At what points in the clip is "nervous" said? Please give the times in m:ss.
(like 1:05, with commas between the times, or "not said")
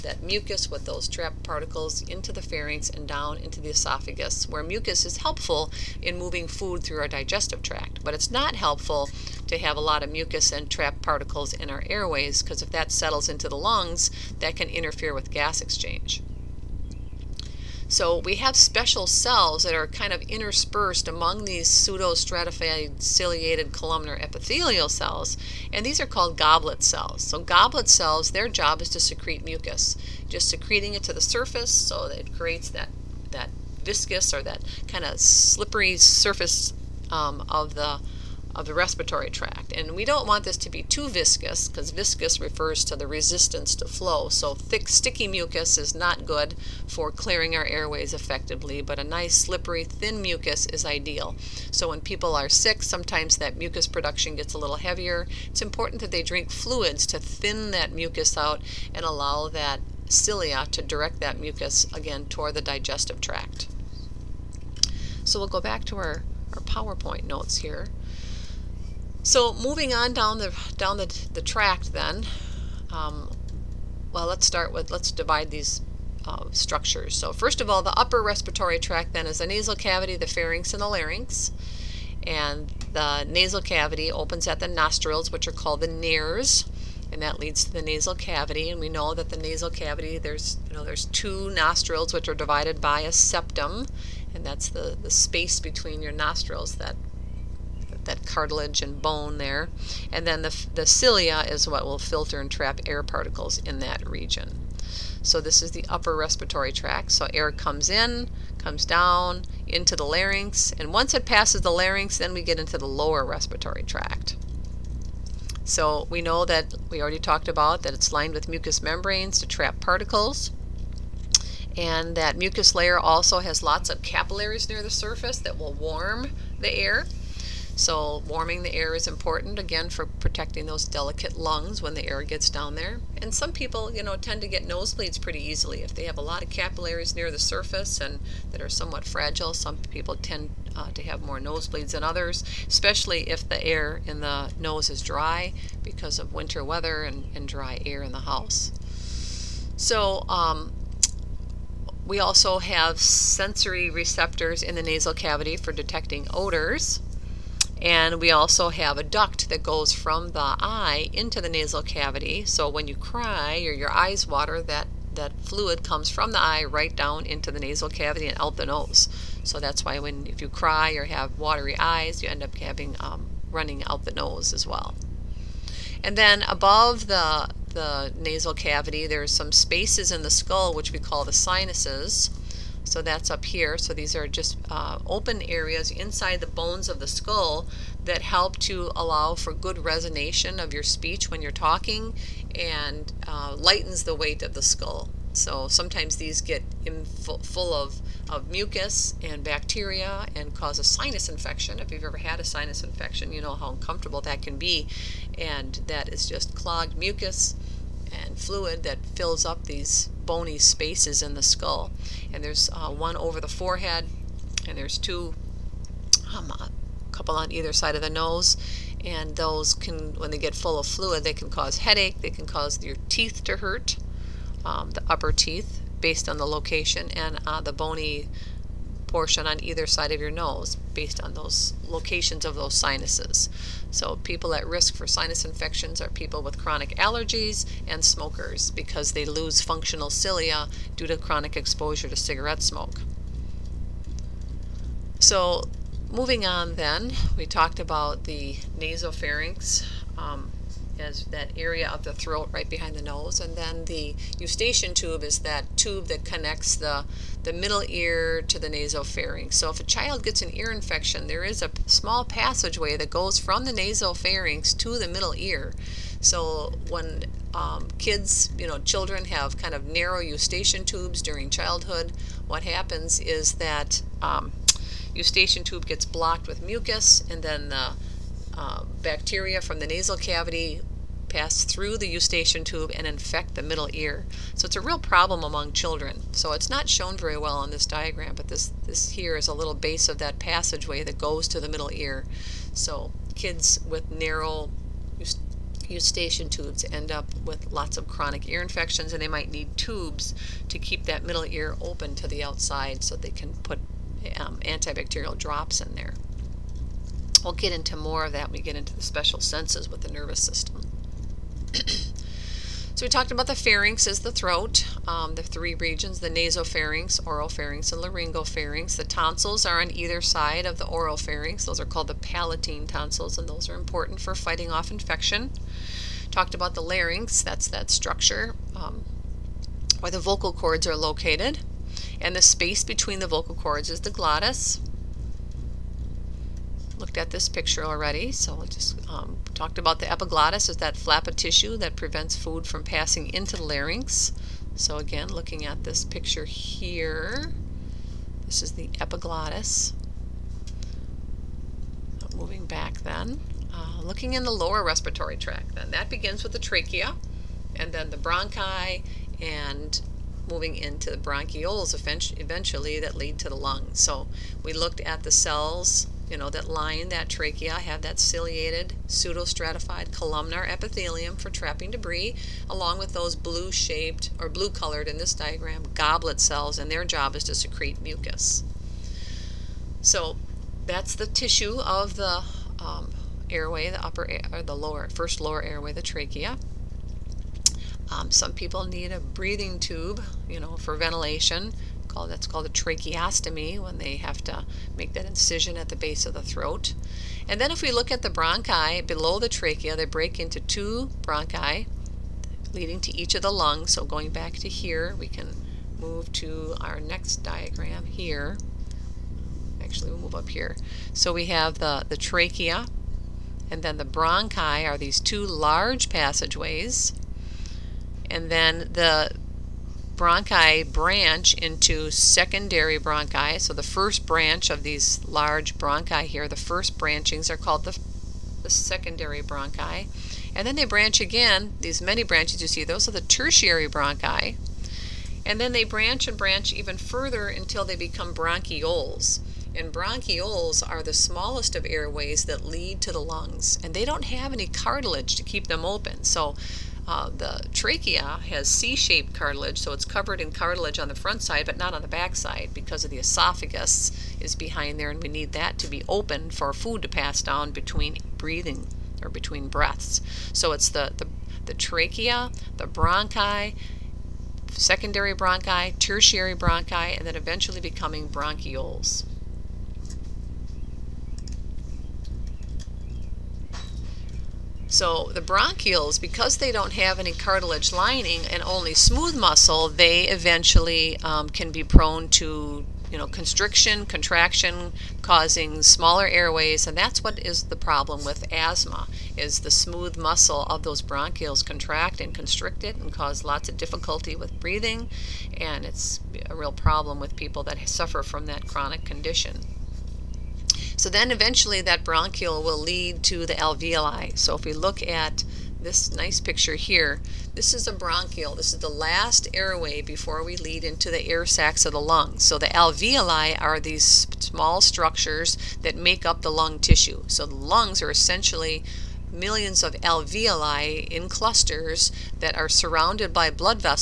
5:10.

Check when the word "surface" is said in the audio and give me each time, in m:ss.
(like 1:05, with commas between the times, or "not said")
0:31, 0:35, 2:04, 2:17.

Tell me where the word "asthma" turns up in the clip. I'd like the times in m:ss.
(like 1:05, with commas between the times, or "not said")
8:08.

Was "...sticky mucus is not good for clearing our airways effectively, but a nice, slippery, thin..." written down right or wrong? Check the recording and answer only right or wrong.
right.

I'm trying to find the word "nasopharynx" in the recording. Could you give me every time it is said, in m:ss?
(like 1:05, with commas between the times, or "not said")
4:08, 4:18, 4:23, 5:16.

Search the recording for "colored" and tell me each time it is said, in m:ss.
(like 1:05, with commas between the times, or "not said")
6:14.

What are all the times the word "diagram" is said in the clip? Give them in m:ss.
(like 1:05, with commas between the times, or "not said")
4:47, 6:15, 6:47.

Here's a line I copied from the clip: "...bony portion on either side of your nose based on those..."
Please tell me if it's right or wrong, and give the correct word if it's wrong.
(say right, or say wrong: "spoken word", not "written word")
right.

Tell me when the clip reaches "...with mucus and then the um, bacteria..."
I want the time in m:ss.
4:36.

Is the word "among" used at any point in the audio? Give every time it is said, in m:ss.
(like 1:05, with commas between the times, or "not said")
0:21, 4:45.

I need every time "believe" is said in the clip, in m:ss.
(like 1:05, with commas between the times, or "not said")
not said.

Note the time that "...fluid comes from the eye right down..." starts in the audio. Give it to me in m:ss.
2:45.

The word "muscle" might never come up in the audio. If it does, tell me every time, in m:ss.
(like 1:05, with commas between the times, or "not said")
7:59, 8:10.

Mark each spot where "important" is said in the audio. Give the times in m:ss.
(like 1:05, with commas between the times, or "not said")
0:55, 2:09, 5:23.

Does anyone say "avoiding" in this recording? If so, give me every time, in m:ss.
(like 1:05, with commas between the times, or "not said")
not said.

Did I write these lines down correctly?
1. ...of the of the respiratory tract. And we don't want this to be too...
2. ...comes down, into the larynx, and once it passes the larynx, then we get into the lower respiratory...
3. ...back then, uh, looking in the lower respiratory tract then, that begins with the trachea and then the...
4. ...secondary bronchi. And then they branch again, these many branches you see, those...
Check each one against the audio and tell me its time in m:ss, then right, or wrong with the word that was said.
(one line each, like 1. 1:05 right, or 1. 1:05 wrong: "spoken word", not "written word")
1. 0:37 right
2. 1:48 right
3. 5:52 right
4. 7:08 right.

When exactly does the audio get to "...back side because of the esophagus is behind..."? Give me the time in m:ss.
7:32.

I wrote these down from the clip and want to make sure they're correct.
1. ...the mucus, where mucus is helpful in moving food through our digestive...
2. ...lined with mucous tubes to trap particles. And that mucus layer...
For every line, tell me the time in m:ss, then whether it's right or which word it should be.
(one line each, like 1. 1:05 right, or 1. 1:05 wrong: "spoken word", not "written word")
1. 0:03 wrong: "esophagus", not "mucus"
2. 1:58 wrong: "membranes", not "tubes".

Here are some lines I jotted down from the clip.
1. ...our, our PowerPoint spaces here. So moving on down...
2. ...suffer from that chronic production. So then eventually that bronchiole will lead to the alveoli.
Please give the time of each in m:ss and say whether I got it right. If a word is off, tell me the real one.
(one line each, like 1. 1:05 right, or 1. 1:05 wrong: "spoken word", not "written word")
1. 1:05 wrong: "notes", not "spaces"
2. 8:17 wrong: "condition", not "production".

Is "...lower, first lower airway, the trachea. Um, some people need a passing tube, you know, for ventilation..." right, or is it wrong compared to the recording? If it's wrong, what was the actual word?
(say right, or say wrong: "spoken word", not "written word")
wrong: "breathing", not "passing".